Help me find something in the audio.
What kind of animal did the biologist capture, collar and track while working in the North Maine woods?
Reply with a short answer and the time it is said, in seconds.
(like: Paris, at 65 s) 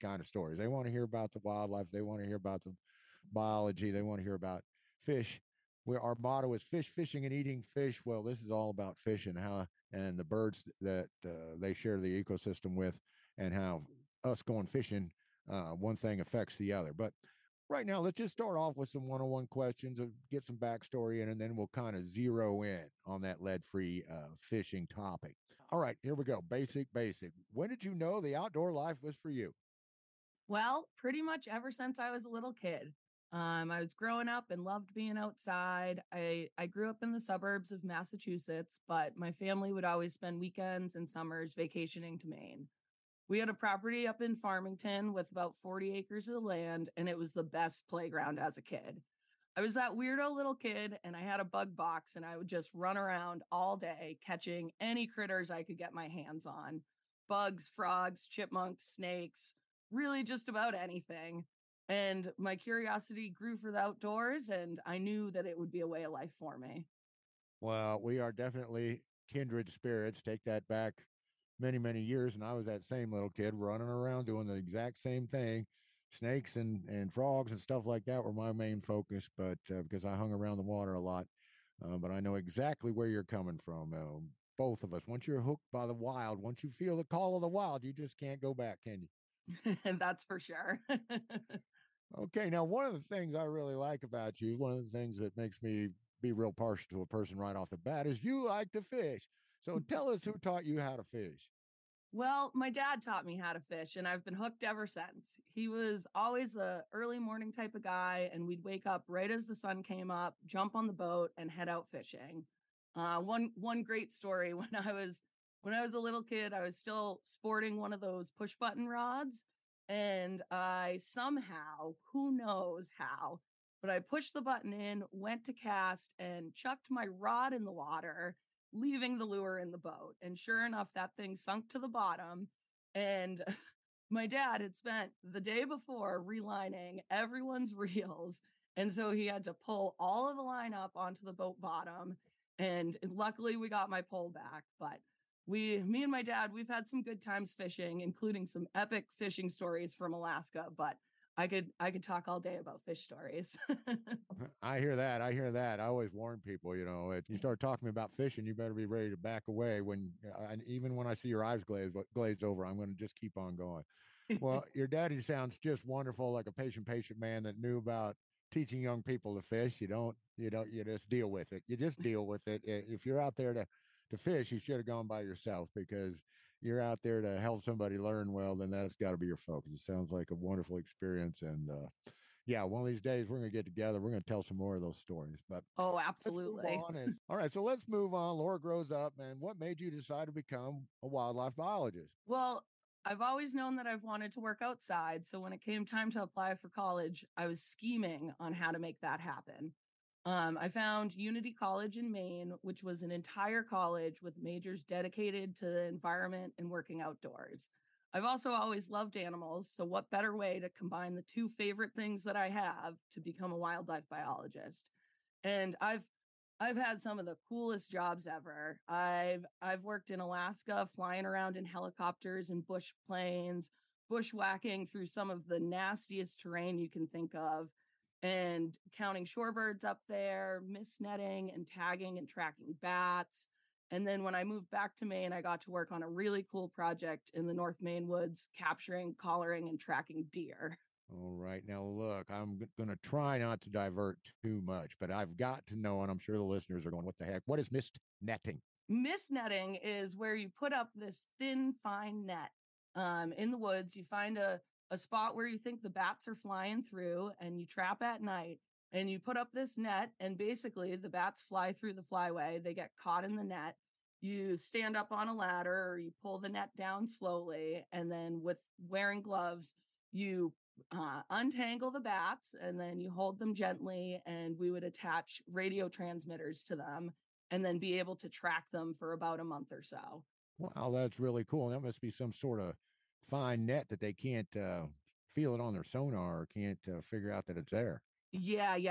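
Deer, at 240 s.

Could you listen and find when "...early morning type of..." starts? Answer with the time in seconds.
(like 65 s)
106 s.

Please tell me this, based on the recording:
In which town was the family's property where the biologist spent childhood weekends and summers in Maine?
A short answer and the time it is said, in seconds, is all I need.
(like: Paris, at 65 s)
Farmington, at 44 s.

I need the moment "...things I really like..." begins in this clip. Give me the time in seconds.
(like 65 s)
93 s.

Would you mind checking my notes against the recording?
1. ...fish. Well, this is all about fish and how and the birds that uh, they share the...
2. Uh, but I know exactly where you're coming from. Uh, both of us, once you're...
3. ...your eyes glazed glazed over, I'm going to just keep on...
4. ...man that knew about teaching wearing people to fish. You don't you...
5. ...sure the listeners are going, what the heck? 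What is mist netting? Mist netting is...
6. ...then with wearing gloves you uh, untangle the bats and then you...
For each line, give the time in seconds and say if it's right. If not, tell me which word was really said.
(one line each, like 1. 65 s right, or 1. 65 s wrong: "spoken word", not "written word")
1. 7 s right
2. 81 s right
3. 161 s right
4. 167 s wrong: "young", not "wearing"
5. 246 s right
6. 268 s right.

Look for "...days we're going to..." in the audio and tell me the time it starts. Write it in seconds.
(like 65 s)
183 s.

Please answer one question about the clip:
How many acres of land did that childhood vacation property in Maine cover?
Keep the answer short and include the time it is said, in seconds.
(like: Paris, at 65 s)
40, at 45 s.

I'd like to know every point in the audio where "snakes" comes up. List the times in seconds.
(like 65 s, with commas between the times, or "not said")
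58 s, 76 s.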